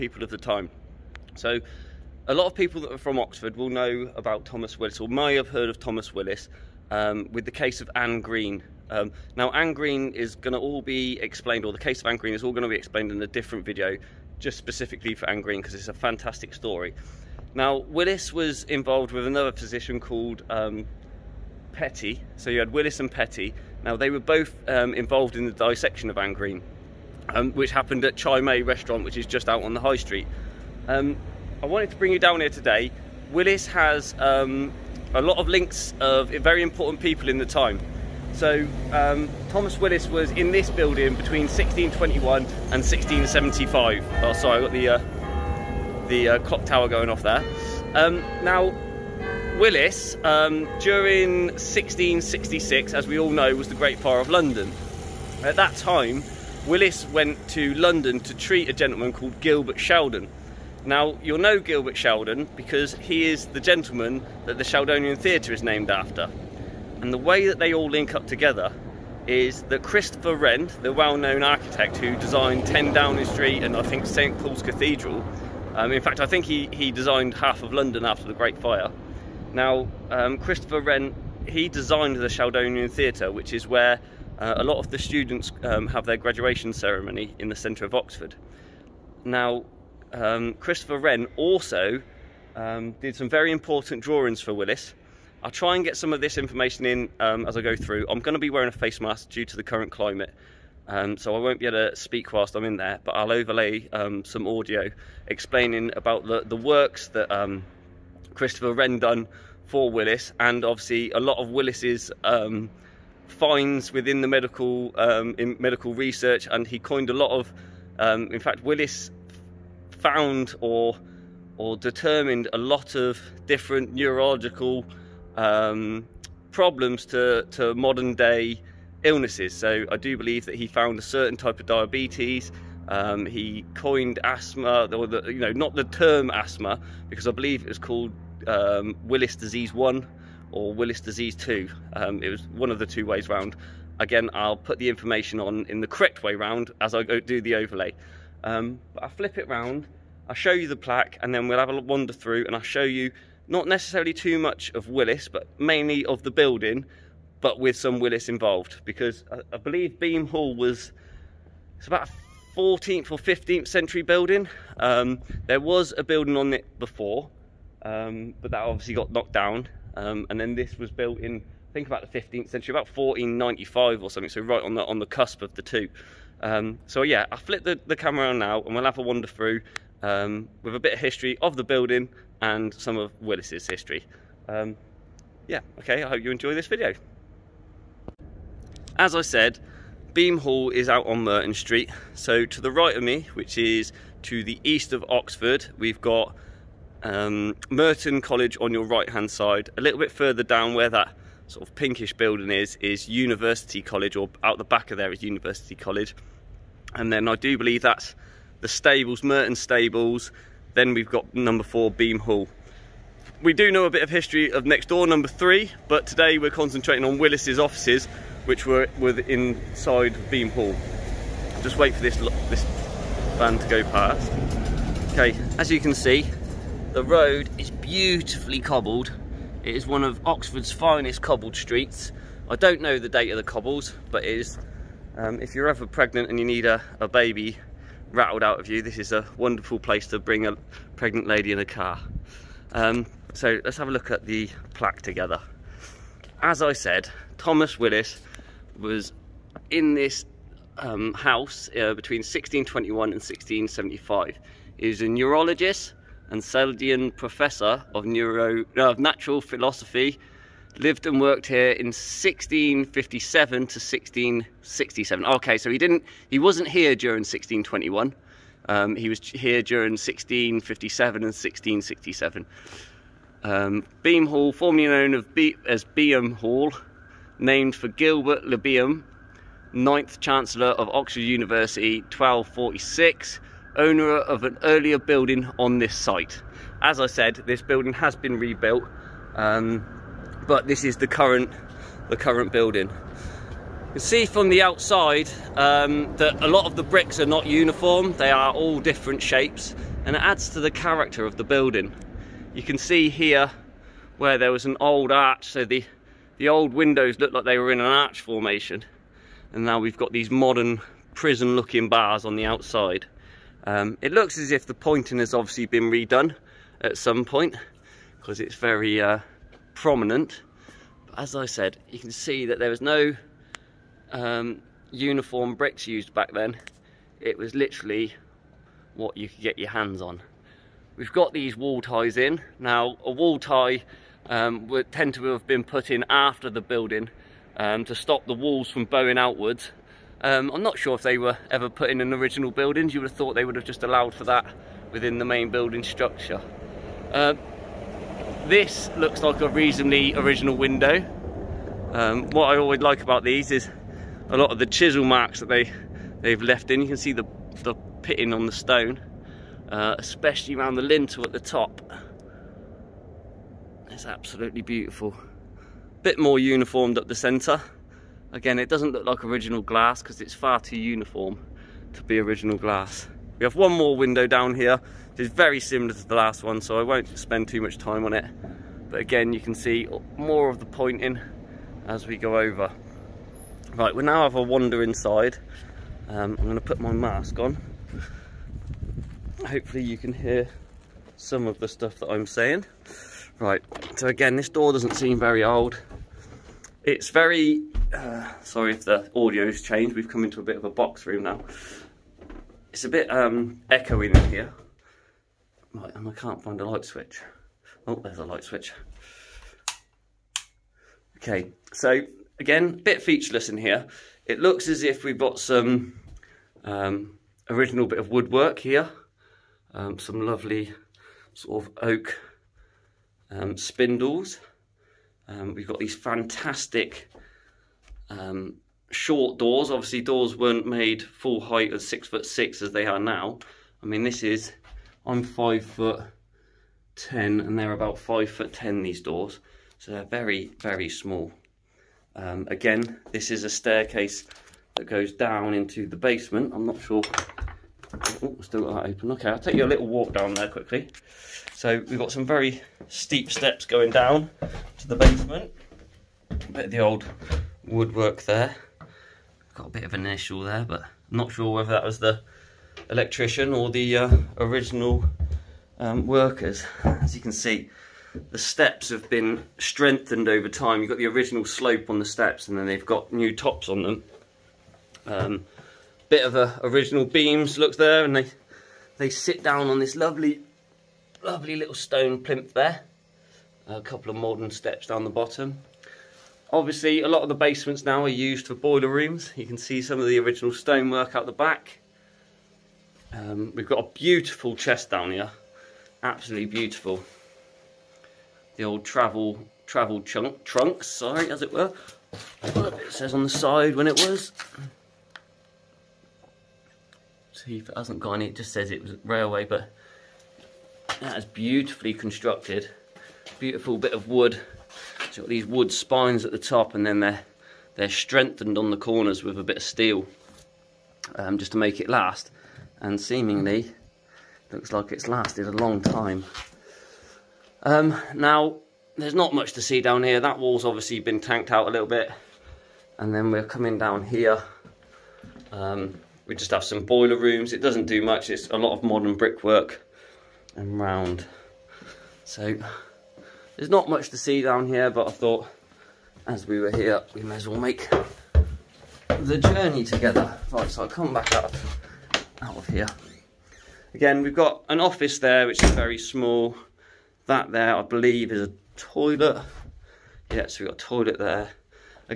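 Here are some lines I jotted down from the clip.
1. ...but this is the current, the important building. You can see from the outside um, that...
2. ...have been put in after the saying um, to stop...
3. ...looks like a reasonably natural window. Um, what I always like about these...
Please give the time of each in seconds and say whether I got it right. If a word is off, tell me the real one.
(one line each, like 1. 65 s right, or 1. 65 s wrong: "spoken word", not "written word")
1. 290 s wrong: "current", not "important"
2. 335 s wrong: "building", not "saying"
3. 348 s wrong: "original", not "natural".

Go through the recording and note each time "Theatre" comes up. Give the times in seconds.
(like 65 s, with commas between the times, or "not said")
65 s, 82 s.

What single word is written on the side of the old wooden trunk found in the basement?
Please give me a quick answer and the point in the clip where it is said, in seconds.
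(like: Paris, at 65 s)
Railway, at 509 s.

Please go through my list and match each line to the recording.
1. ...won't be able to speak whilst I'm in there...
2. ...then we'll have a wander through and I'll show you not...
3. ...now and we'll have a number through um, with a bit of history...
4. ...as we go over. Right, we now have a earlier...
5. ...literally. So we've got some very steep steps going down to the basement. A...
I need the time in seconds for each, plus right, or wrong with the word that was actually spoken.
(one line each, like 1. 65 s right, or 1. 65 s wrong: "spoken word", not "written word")
1. 101 s right
2. 151 s right
3. 178 s wrong: "wander", not "number"
4. 381 s wrong: "wander", not "earlier"
5. 450 s wrong: "quickly", not "literally".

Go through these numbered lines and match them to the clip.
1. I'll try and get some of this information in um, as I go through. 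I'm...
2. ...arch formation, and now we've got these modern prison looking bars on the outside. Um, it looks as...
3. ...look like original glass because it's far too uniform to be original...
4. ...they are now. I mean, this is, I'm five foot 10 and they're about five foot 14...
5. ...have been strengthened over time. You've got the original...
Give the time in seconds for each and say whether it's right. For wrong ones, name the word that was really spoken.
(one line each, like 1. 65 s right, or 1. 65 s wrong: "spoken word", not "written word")
1. 95 s right
2. 307 s right
3. 368 s right
4. 432 s wrong: "10", not "14"
5. 468 s right.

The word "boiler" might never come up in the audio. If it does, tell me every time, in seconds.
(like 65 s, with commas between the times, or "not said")
488 s, 536 s.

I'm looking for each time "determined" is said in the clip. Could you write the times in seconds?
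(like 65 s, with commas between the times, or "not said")
121 s.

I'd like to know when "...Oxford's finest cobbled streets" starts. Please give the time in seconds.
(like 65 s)
230 s.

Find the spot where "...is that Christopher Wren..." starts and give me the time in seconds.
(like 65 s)
69 s.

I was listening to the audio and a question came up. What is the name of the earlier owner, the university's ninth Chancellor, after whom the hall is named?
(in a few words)
Gilbert Le Beam.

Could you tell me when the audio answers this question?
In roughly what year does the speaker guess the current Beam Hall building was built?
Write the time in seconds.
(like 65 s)
172 s.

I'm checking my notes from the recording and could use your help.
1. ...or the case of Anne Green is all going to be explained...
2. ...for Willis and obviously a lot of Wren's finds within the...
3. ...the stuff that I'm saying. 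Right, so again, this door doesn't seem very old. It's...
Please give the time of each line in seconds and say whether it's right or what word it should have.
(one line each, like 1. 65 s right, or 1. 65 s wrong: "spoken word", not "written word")
1. 11 s right
2. 109 s wrong: "Willis", not "Wren"
3. 391 s right.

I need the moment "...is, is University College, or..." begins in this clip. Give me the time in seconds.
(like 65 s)
202 s.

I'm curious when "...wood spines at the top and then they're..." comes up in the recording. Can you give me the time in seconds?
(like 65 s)
515 s.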